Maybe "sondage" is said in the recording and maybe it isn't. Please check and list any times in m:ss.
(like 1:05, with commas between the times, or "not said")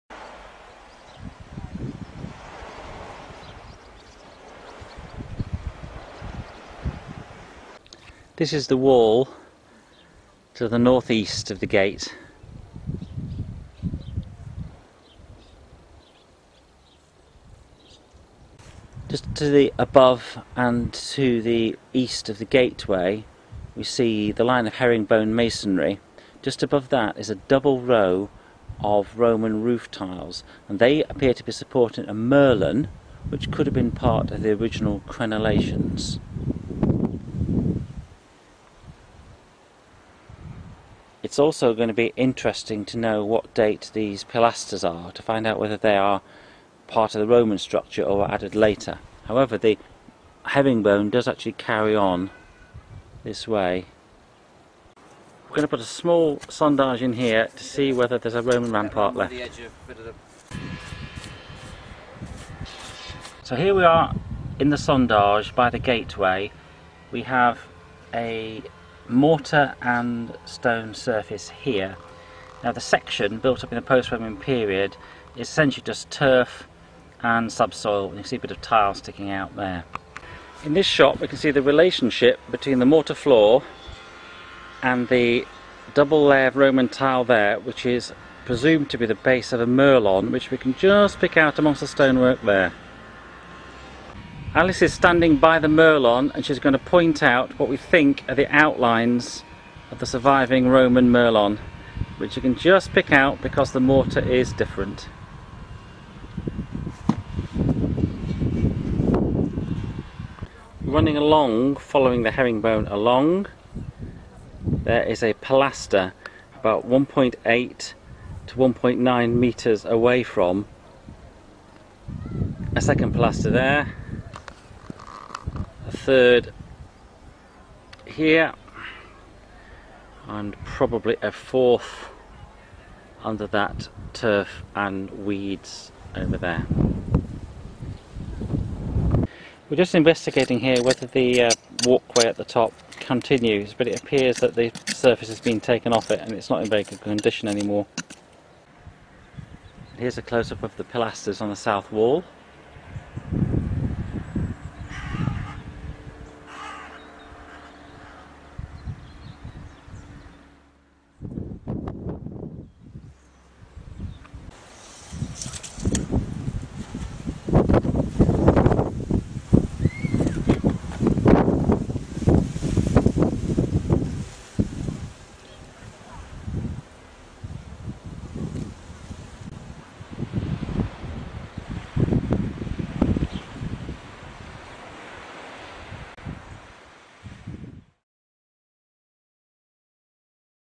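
0:56, 1:04.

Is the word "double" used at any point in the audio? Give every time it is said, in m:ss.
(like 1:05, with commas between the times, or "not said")
0:27, 1:25.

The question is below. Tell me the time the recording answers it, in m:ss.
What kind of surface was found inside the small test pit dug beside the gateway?
1:09.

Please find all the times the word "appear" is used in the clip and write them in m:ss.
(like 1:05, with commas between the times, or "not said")
0:31, 2:24.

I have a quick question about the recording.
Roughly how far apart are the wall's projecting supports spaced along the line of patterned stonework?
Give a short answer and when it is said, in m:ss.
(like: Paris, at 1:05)
1.8 to 1.9 metres, at 1:56.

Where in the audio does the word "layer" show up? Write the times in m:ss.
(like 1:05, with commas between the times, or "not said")
1:26.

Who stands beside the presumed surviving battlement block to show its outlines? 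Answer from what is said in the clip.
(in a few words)
Alice.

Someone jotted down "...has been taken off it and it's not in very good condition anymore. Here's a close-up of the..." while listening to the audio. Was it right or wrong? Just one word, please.
right.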